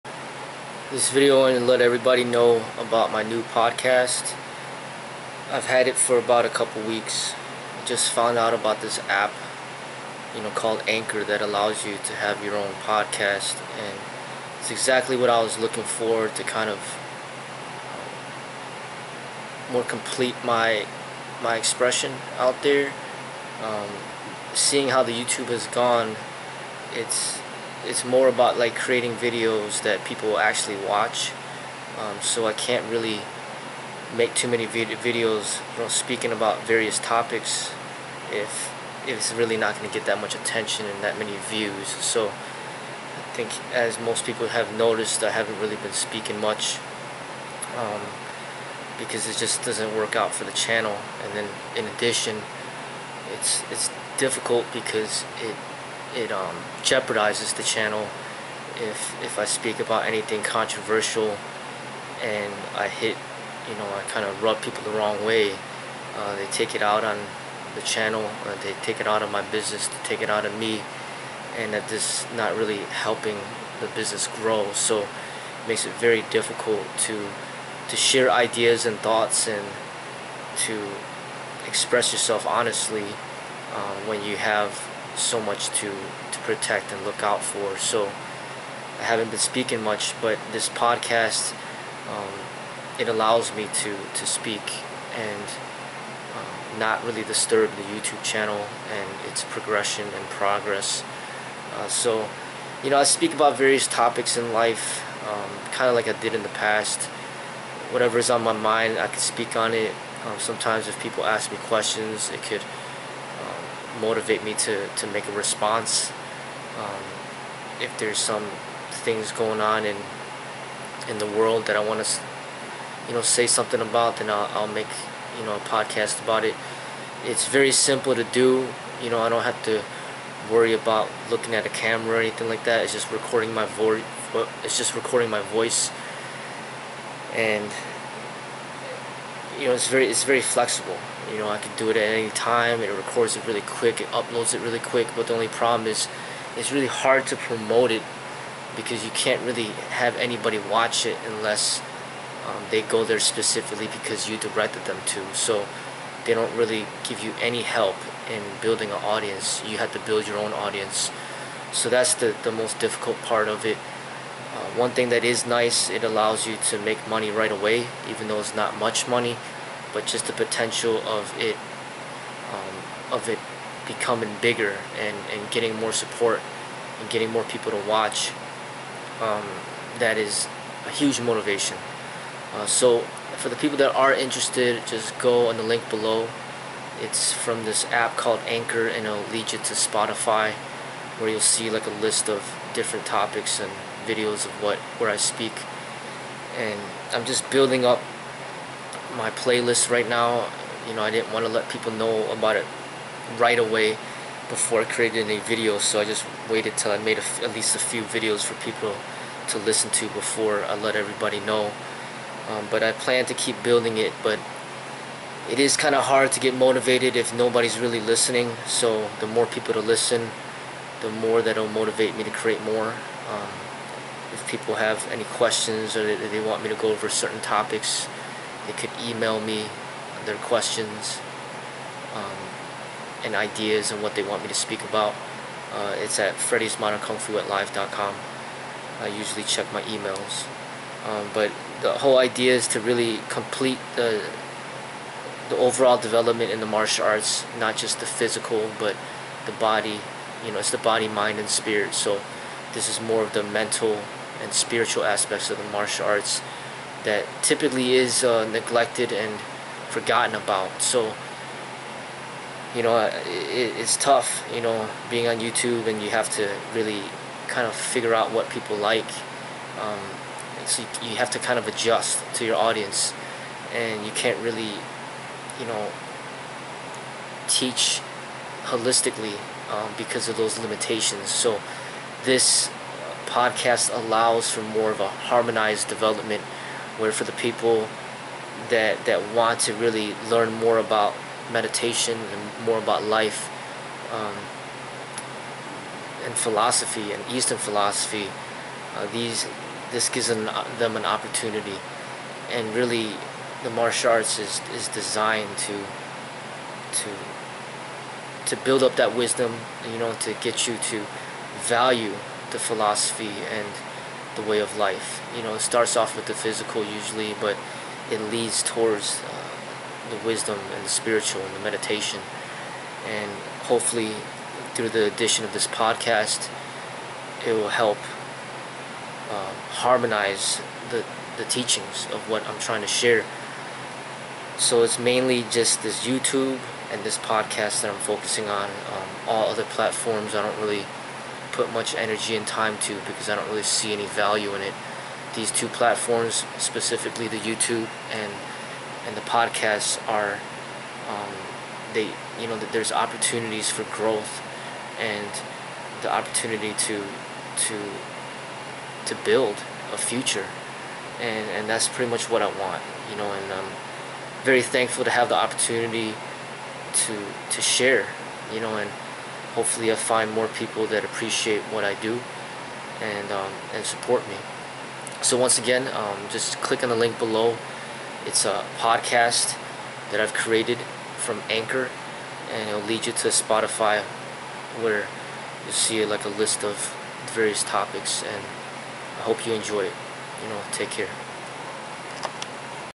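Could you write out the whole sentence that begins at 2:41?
So that's the, the most difficult part of it.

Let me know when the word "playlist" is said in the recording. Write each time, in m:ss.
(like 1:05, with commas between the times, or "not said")
3:19.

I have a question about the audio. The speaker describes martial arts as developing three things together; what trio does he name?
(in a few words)
body, mind, and spirit.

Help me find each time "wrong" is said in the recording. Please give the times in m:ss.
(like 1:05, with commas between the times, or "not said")
1:04.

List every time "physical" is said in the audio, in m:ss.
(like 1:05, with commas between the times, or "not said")
4:08, 5:16.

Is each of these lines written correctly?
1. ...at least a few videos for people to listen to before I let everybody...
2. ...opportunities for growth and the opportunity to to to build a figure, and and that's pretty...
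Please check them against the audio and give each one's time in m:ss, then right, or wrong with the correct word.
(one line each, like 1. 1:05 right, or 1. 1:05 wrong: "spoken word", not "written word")
1. 3:27 right
2. 5:52 wrong: "future", not "figure".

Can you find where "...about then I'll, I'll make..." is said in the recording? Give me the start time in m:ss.
2:03.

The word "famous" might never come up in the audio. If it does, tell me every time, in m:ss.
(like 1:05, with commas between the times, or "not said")
not said.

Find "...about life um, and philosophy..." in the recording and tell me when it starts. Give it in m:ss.
4:52.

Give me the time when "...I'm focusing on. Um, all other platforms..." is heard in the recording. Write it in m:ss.
5:37.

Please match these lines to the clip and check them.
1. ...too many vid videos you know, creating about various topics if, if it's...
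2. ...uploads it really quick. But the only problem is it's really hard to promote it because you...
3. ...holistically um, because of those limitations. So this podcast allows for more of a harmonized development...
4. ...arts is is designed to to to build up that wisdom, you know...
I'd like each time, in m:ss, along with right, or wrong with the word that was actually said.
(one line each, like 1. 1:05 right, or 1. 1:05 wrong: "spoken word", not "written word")
1. 0:34 wrong: "speaking", not "creating"
2. 2:24 right
3. 4:38 right
4. 5:04 right.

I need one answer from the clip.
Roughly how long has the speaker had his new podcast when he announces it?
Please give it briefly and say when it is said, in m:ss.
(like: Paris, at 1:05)
a couple weeks, at 0:06.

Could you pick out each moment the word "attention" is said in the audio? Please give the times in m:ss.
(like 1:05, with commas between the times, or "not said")
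0:40.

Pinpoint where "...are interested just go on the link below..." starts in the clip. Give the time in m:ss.
3:03.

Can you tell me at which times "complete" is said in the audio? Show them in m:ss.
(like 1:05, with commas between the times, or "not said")
0:19, 4:03.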